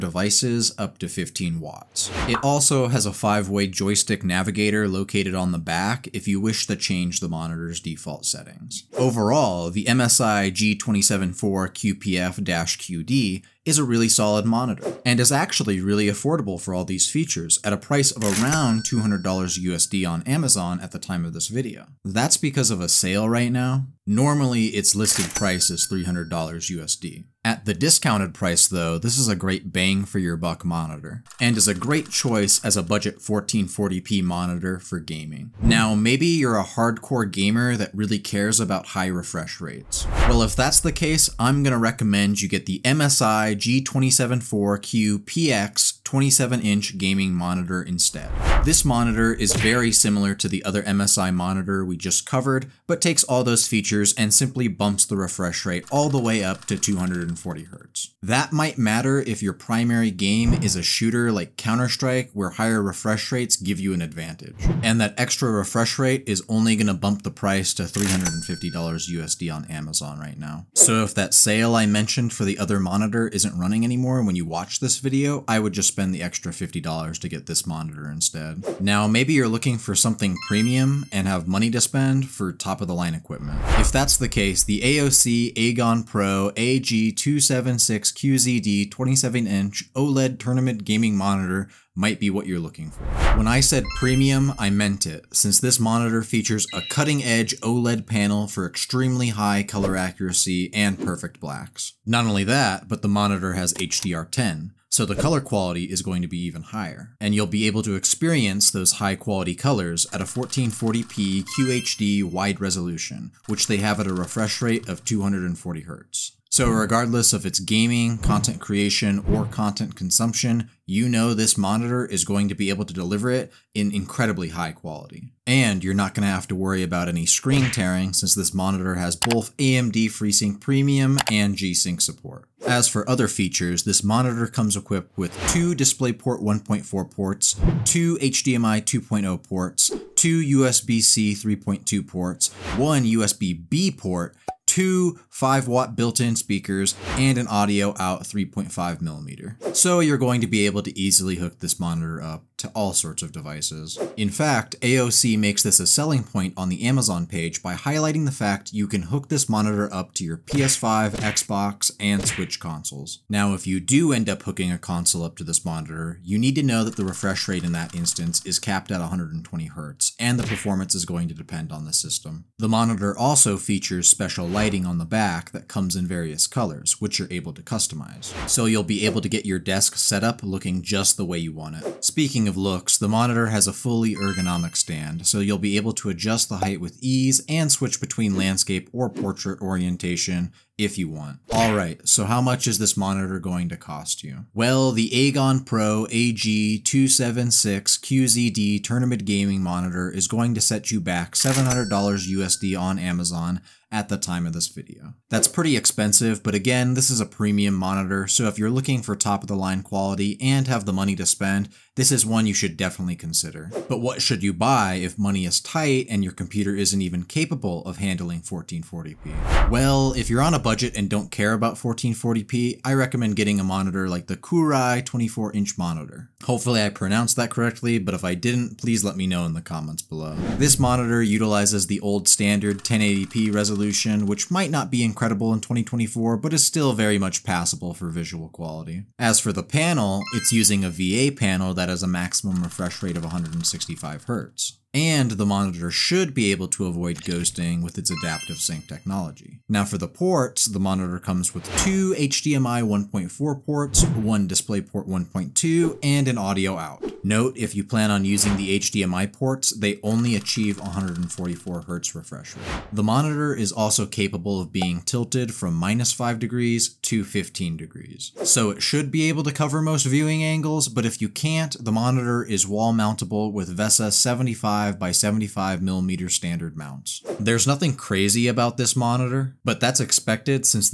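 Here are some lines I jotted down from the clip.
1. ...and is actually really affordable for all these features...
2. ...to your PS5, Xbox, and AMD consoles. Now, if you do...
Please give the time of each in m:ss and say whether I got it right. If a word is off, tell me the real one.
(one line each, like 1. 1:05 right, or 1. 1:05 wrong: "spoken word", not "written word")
1. 0:15 right
2. 2:40 wrong: "Switch", not "AMD".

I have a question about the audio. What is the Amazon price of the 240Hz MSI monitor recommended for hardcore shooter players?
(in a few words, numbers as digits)
$350.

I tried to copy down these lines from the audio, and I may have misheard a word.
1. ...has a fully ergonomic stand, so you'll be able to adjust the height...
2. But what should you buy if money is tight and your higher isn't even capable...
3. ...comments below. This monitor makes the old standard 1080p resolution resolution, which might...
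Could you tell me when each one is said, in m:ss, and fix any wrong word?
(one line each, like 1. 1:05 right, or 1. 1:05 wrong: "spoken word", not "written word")
1. 3:03 right
2. 3:33 wrong: "computer", not "higher"
3. 3:49 wrong: "utilizes", not "makes".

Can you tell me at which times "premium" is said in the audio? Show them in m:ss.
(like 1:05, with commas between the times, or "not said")
1:20, 1:33, 2:10, 3:27.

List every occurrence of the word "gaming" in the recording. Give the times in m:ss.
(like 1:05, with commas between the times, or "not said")
0:34, 0:46, 1:30, 1:57, 3:19.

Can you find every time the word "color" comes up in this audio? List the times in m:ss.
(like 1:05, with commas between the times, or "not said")
1:39, 1:45, 1:49, 2:56.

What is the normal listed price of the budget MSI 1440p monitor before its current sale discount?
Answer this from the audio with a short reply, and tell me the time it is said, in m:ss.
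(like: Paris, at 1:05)
$300, at 0:25.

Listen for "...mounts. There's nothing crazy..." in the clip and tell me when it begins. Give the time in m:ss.
4:36.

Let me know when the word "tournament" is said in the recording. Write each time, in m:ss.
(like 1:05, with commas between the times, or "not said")
1:30, 3:18.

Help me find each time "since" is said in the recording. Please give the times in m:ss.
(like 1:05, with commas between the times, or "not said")
1:35, 2:08.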